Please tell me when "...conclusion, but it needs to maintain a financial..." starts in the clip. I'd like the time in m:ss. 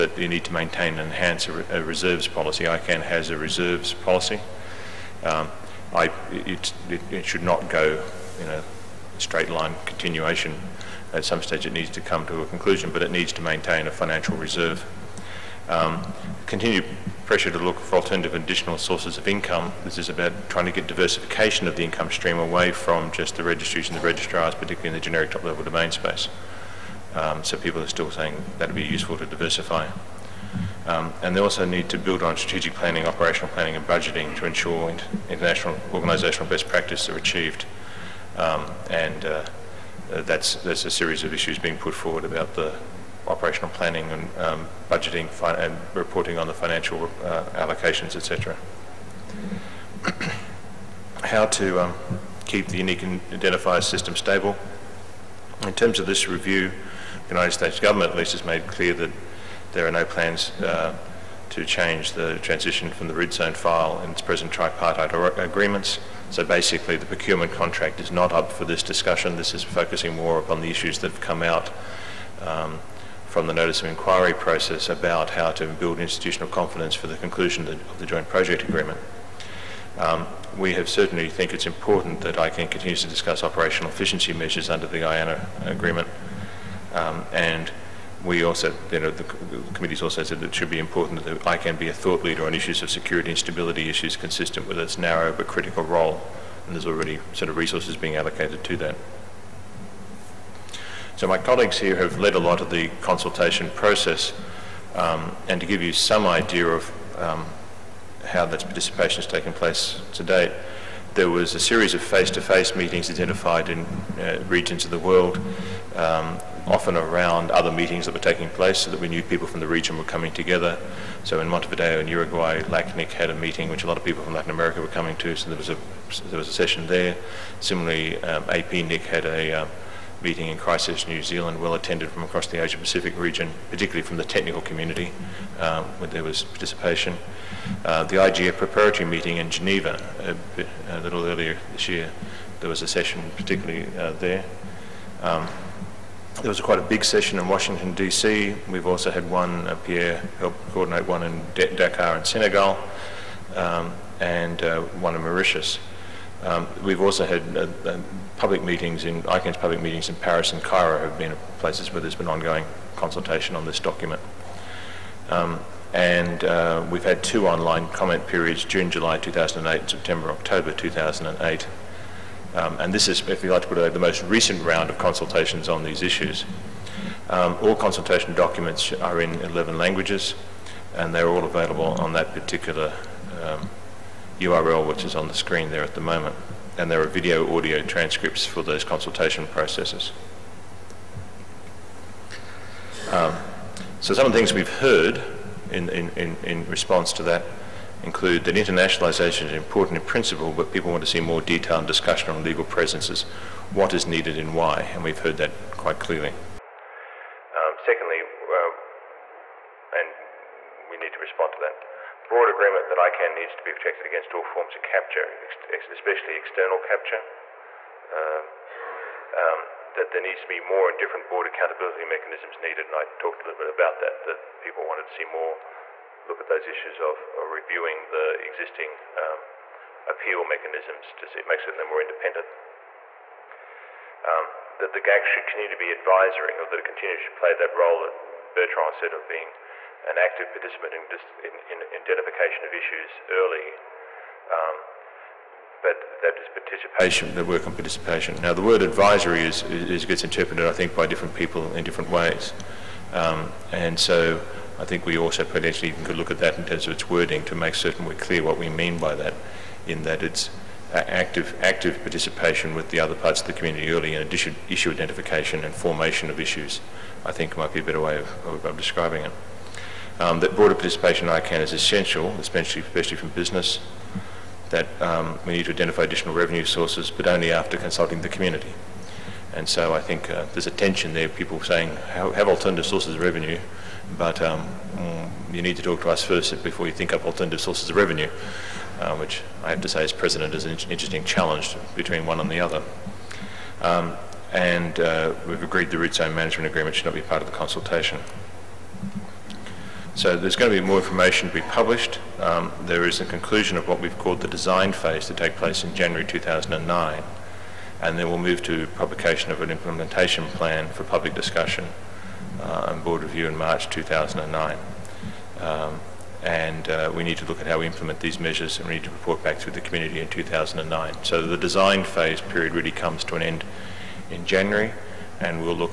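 0:12.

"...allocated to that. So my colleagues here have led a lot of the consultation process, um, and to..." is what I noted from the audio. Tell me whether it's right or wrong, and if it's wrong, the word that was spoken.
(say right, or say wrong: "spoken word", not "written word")
right.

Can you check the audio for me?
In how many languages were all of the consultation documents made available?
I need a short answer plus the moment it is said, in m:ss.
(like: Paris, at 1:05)
11, at 2:59.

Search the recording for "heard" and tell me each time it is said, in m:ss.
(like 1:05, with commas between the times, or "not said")
3:14, 3:25.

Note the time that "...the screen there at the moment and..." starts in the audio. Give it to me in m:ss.
3:05.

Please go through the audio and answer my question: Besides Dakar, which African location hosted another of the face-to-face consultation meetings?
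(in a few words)
Mauritius.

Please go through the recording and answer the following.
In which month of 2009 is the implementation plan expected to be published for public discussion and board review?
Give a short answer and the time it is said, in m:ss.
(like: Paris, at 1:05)
March, at 5:13.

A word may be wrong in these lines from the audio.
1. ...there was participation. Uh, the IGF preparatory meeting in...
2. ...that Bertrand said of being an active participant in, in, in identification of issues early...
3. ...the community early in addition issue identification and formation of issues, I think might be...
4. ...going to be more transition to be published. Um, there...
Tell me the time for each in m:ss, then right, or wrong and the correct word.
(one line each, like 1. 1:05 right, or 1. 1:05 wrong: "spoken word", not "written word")
1. 2:16 right
2. 3:58 right
3. 4:23 right
4. 5:00 wrong: "information", not "transition".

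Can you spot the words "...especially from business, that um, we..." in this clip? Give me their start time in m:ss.
4:32.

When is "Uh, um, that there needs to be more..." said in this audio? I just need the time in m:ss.
3:38.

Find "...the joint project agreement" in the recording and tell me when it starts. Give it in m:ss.
1:17.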